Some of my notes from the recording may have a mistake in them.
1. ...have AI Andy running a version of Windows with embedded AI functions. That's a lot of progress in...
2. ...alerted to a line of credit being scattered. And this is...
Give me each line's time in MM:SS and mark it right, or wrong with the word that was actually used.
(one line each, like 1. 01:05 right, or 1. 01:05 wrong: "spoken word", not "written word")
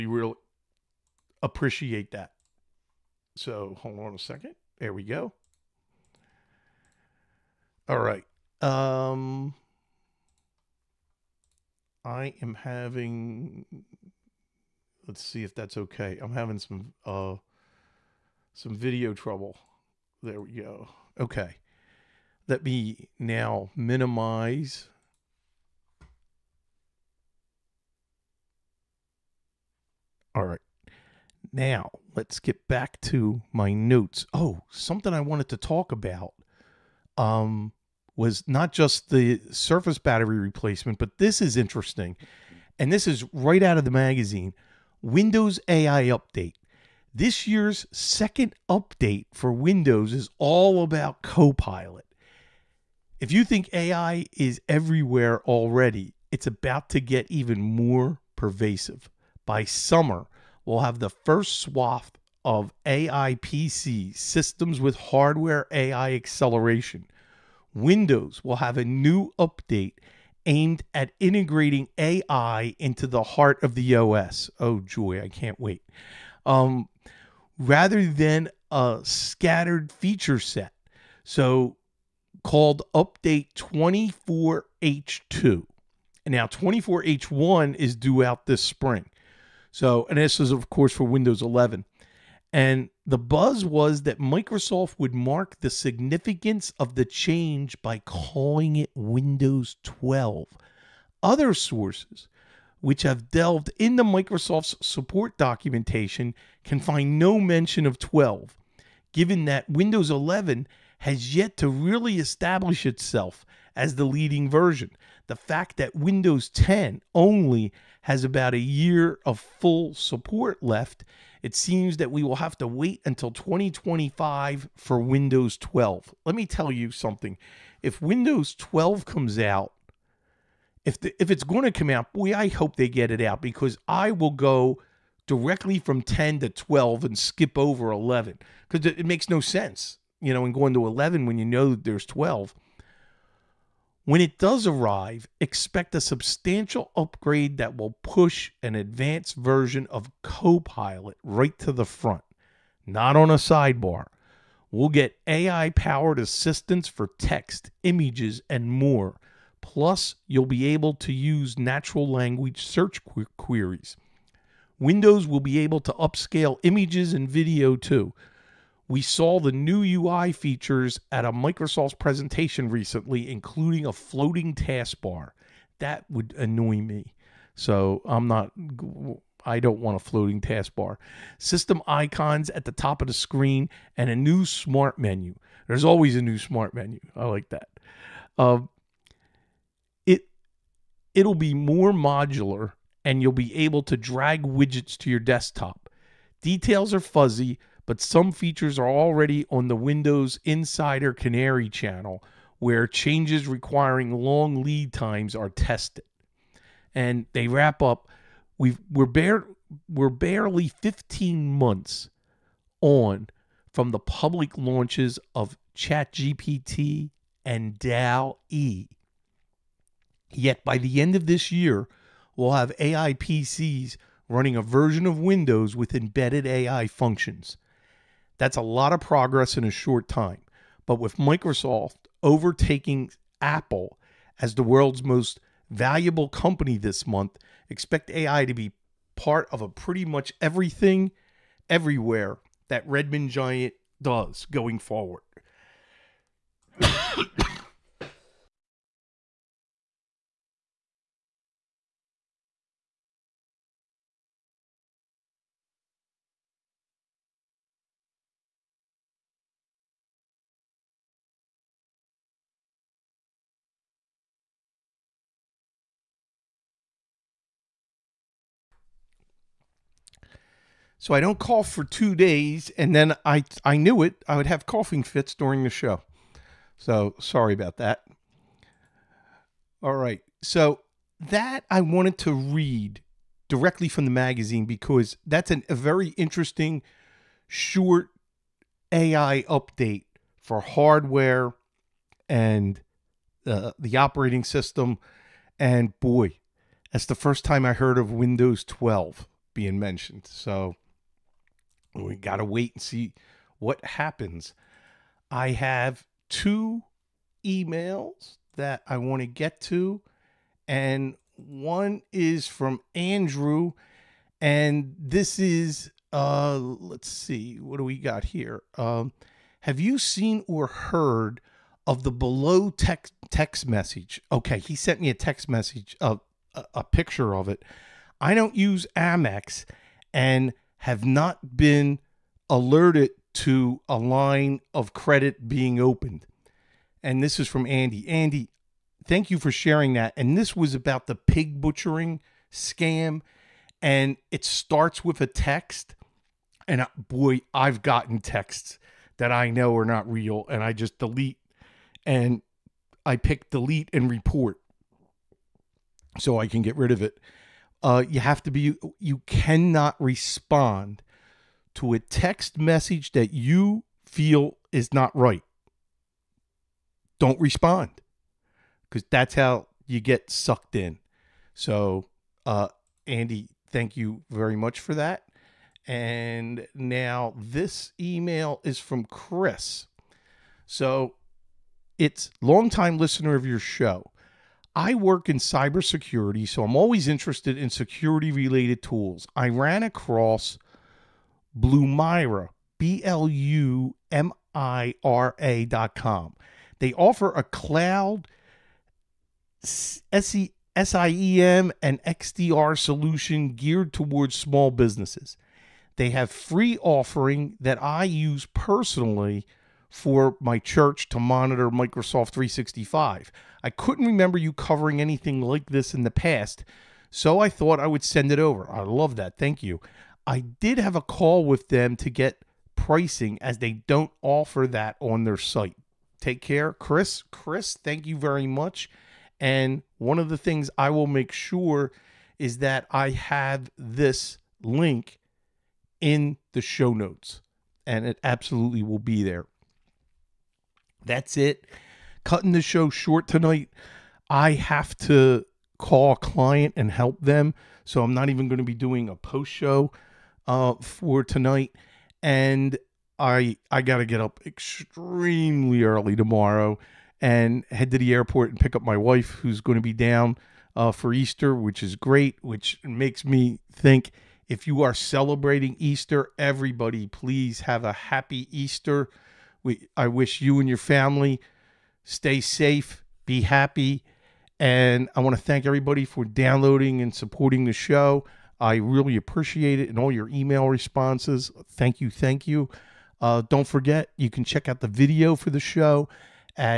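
1. 03:42 wrong: "PCs", not "Andy"
2. 05:32 wrong: "opened", not "scattered".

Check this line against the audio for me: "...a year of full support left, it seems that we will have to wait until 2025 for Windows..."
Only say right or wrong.
right.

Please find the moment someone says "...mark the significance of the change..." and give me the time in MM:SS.
01:35.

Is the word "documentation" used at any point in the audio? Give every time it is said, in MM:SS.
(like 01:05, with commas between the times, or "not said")
01:45.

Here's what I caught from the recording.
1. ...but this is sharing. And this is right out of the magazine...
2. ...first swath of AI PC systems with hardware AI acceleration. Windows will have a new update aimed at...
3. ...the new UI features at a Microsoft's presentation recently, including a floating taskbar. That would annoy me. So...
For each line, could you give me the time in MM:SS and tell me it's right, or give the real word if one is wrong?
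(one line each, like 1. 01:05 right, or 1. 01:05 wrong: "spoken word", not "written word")
1. 00:40 wrong: "interesting", not "sharing"
2. 01:01 right
3. 02:49 right.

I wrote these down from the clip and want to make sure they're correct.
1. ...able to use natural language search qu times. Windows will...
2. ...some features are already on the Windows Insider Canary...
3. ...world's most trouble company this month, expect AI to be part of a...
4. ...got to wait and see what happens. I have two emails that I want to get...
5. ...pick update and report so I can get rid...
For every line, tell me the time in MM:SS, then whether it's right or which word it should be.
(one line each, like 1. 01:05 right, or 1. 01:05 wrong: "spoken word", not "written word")
1. 02:40 wrong: "queries", not "times"
2. 03:17 right
3. 03:54 wrong: "valuable", not "trouble"
4. 05:02 right
5. 05:53 wrong: "delete", not "update".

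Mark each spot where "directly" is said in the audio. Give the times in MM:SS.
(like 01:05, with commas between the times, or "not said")
02:15, 04:43.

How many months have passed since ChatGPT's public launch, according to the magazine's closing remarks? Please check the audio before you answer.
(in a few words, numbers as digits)
15.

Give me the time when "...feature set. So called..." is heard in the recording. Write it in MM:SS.
01:19.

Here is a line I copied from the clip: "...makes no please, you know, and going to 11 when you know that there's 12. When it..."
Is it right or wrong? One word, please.
wrong.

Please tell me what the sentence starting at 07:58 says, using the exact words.
I really appreciate it and all your email responses.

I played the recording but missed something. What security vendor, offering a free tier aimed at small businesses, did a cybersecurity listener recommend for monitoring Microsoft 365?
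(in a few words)
Blumira.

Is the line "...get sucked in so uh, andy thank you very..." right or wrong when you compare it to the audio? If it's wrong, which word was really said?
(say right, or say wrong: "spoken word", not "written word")
right.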